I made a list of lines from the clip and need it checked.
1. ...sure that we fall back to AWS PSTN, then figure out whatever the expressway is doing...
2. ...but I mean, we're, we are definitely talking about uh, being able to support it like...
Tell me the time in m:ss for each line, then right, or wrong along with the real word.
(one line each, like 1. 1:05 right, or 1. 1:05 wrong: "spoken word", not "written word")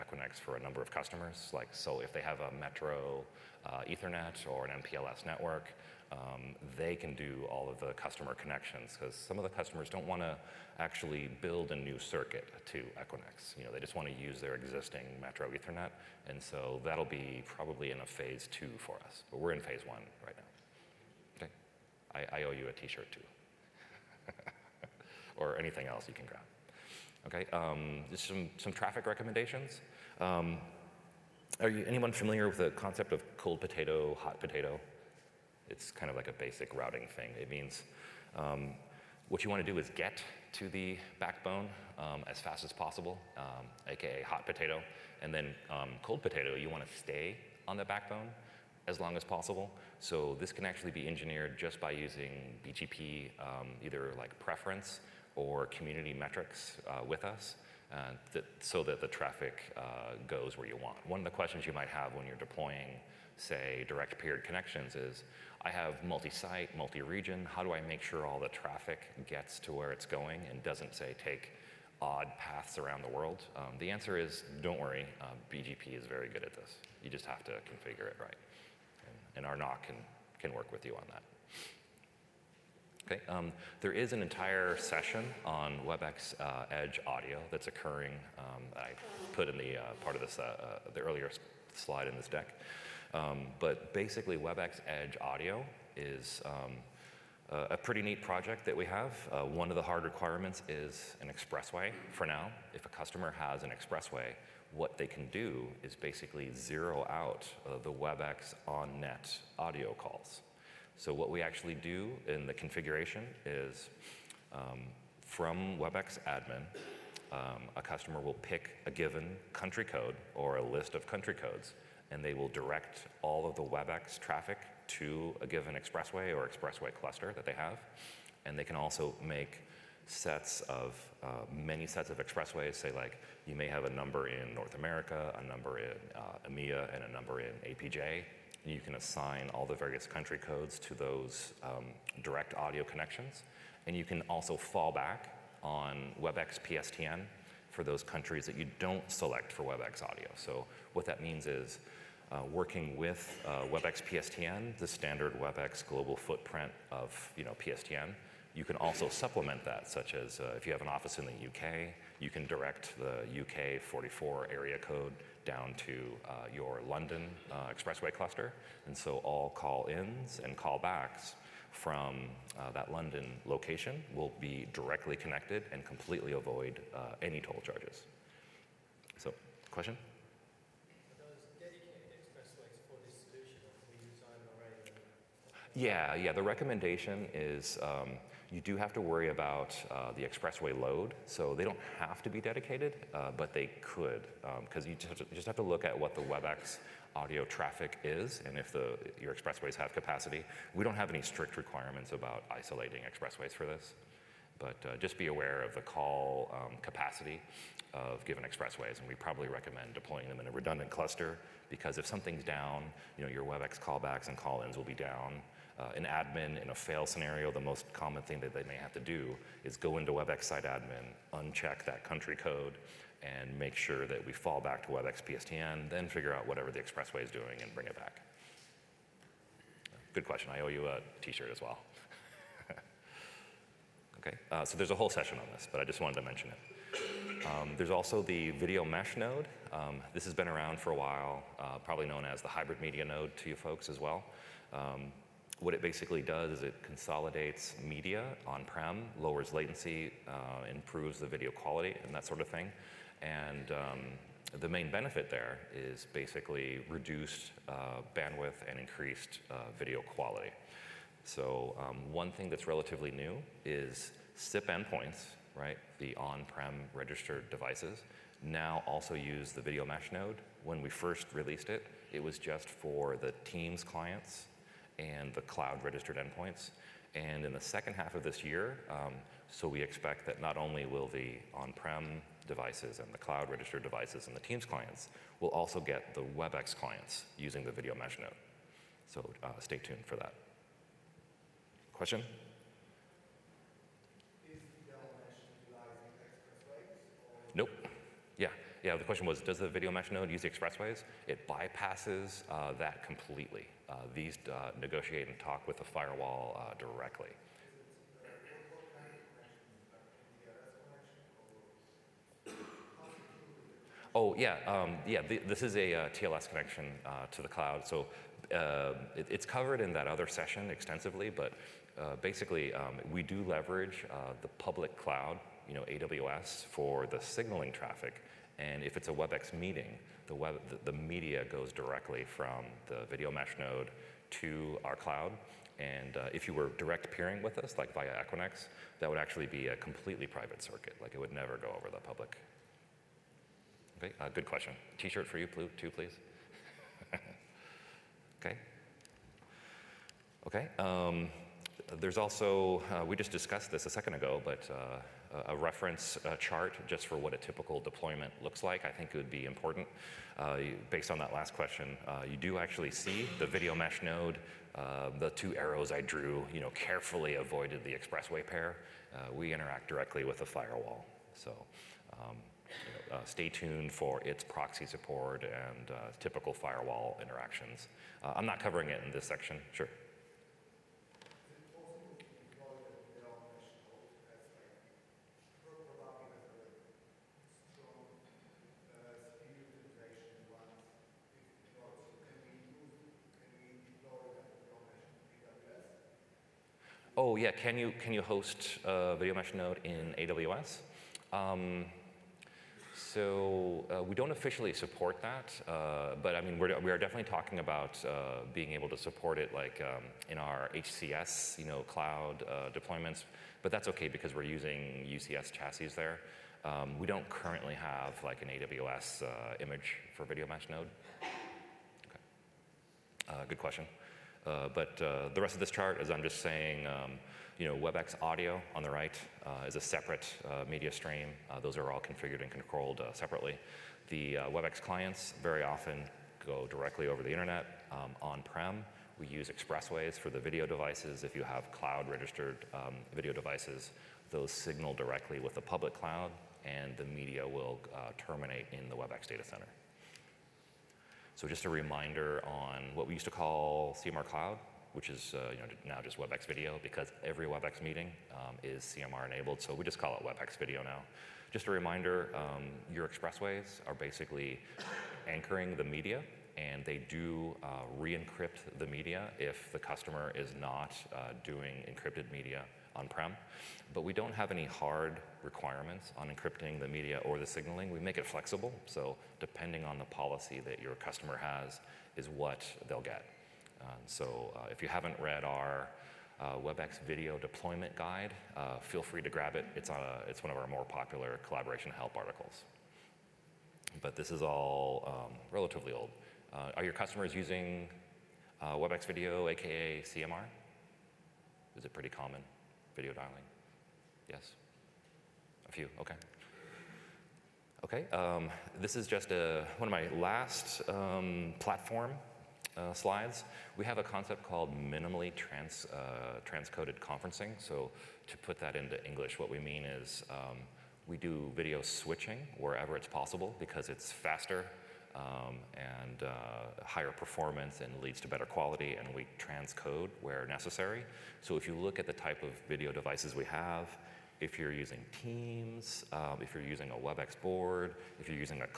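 1. 3:43 wrong: "WebEx", not "AWS"
2. 6:46 right.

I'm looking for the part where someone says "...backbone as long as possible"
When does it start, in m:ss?
0:47.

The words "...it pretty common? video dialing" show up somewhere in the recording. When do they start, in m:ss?
8:21.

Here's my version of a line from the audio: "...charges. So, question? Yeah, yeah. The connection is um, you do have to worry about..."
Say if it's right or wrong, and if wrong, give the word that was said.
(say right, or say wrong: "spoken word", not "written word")
wrong: "recommendation", not "connection".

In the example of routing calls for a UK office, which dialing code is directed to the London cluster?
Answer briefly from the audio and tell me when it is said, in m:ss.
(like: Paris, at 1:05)
44, at 2:43.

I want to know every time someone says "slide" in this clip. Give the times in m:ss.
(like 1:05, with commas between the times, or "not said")
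1:31, 8:32.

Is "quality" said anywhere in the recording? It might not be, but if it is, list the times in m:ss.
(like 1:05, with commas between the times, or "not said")
4:11, 4:20, 8:48.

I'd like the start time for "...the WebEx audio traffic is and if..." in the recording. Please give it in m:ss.
3:16.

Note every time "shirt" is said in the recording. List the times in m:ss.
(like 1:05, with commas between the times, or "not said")
0:22, 3:51, 5:44.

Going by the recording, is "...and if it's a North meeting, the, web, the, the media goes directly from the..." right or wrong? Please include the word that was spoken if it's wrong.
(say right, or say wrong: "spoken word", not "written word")
wrong: "WebEx", not "North".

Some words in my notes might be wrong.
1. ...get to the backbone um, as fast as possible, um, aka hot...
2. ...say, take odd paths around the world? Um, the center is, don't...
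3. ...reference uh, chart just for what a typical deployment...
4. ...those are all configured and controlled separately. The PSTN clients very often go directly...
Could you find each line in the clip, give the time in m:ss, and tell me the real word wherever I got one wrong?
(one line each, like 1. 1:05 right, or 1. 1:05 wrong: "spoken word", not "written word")
1. 0:39 right
2. 1:10 wrong: "answer", not "center"
3. 5:55 right
4. 7:11 wrong: "WebEx", not "PSTN".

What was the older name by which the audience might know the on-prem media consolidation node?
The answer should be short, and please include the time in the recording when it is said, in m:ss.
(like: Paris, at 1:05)
Hybrid media node, at 4:02.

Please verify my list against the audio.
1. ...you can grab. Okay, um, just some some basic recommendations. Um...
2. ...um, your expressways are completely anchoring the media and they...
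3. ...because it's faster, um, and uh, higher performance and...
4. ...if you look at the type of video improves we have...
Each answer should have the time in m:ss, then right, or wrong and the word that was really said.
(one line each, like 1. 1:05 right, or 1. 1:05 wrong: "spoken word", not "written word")
1. 0:26 wrong: "traffic", not "basic"
2. 7:42 wrong: "basically", not "completely"
3. 8:43 right
4. 8:51 wrong: "devices", not "improves".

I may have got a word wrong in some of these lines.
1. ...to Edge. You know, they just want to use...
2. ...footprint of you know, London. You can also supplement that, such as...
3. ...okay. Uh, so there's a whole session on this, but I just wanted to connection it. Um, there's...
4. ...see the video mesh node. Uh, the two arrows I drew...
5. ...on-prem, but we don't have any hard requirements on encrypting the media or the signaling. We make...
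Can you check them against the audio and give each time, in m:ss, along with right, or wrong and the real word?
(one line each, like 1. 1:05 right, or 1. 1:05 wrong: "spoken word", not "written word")
1. 0:12 wrong: "Equinix", not "Edge"
2. 2:36 wrong: "PSTN", not "London"
3. 3:54 wrong: "mention", not "connection"
4. 6:02 right
5. 7:52 right.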